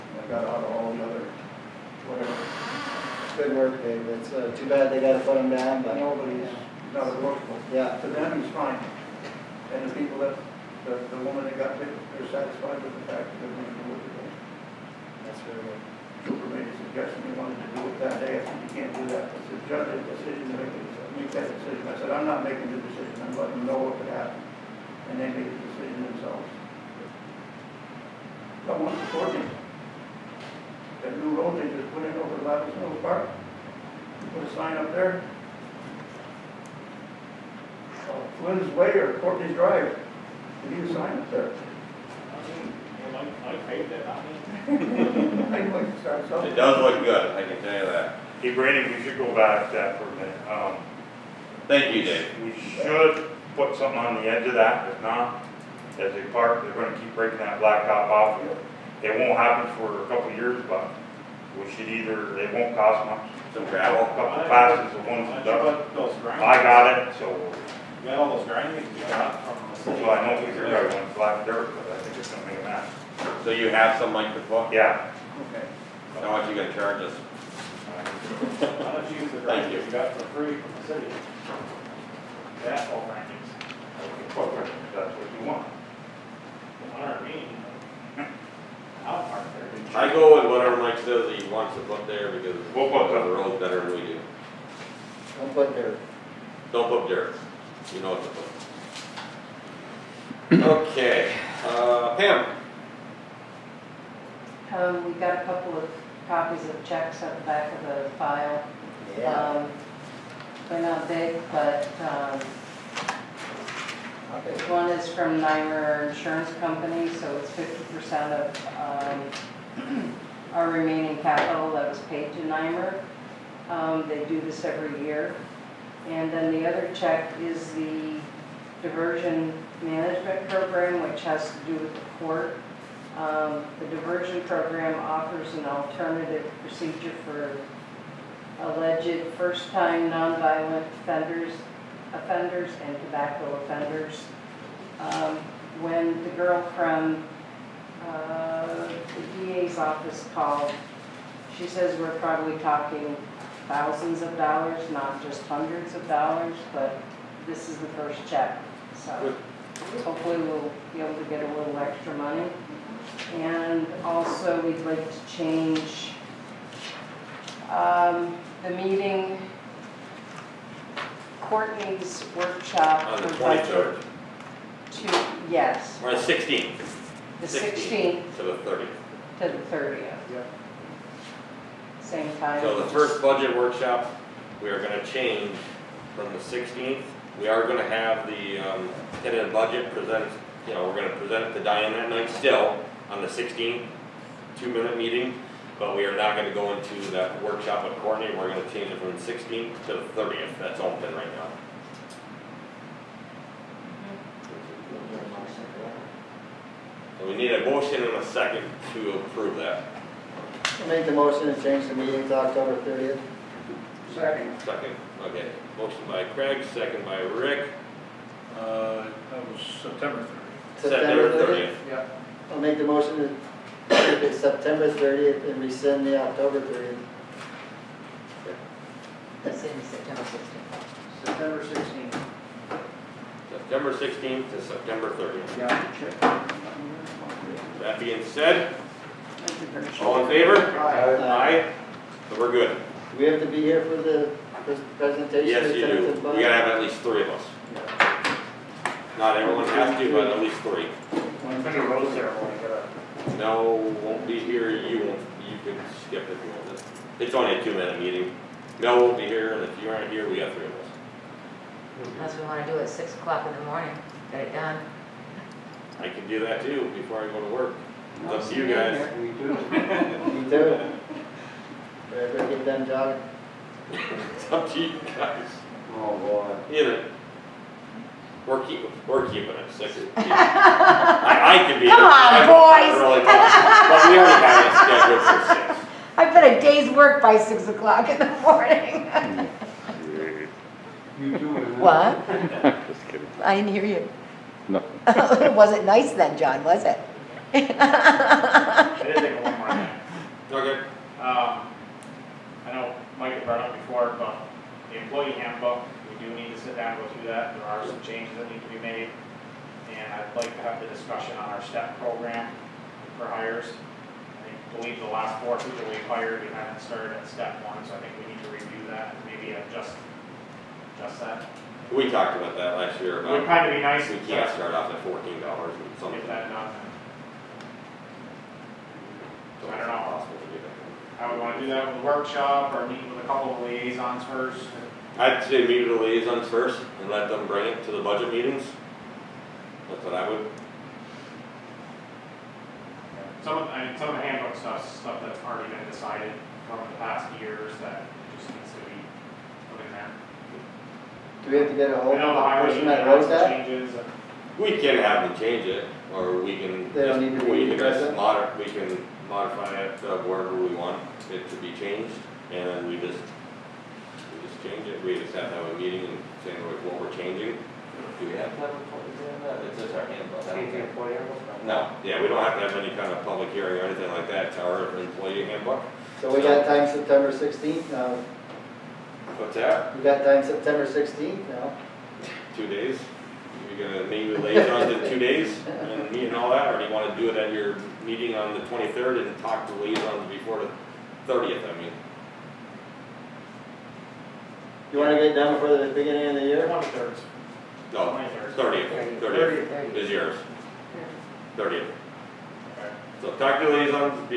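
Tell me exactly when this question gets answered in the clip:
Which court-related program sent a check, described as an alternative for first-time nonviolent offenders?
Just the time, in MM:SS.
02:08.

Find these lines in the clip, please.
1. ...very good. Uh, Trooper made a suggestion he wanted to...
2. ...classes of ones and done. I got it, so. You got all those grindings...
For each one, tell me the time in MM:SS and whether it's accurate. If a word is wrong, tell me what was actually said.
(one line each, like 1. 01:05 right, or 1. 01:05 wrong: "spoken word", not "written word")
1. 00:15 right
2. 01:04 right.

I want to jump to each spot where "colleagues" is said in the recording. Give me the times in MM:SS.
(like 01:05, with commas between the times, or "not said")
not said.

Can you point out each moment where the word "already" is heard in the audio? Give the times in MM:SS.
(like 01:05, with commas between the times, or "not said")
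04:45, 05:45.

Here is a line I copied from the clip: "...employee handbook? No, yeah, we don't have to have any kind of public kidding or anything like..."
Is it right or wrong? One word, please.
wrong.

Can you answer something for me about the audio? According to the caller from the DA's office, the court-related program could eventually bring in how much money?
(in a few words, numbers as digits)
Thousands of dollars.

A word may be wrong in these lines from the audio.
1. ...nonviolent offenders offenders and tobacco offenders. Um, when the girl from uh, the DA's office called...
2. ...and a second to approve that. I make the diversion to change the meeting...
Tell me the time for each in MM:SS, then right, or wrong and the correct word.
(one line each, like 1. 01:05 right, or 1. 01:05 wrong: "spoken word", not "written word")
1. 02:20 right
2. 03:28 wrong: "motion", not "diversion".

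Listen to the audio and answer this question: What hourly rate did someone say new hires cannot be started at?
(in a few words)
$14 and something.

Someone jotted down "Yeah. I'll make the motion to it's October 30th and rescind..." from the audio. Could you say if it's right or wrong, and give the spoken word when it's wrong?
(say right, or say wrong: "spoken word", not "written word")
wrong: "September", not "October".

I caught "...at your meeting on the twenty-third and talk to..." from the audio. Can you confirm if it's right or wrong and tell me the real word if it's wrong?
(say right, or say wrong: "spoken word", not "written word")
right.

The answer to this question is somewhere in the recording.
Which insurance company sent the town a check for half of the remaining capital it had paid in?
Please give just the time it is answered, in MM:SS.
01:55.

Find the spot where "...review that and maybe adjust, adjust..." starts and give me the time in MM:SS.
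05:18.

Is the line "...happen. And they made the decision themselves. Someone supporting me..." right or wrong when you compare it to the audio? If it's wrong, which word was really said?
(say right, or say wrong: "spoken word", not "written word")
right.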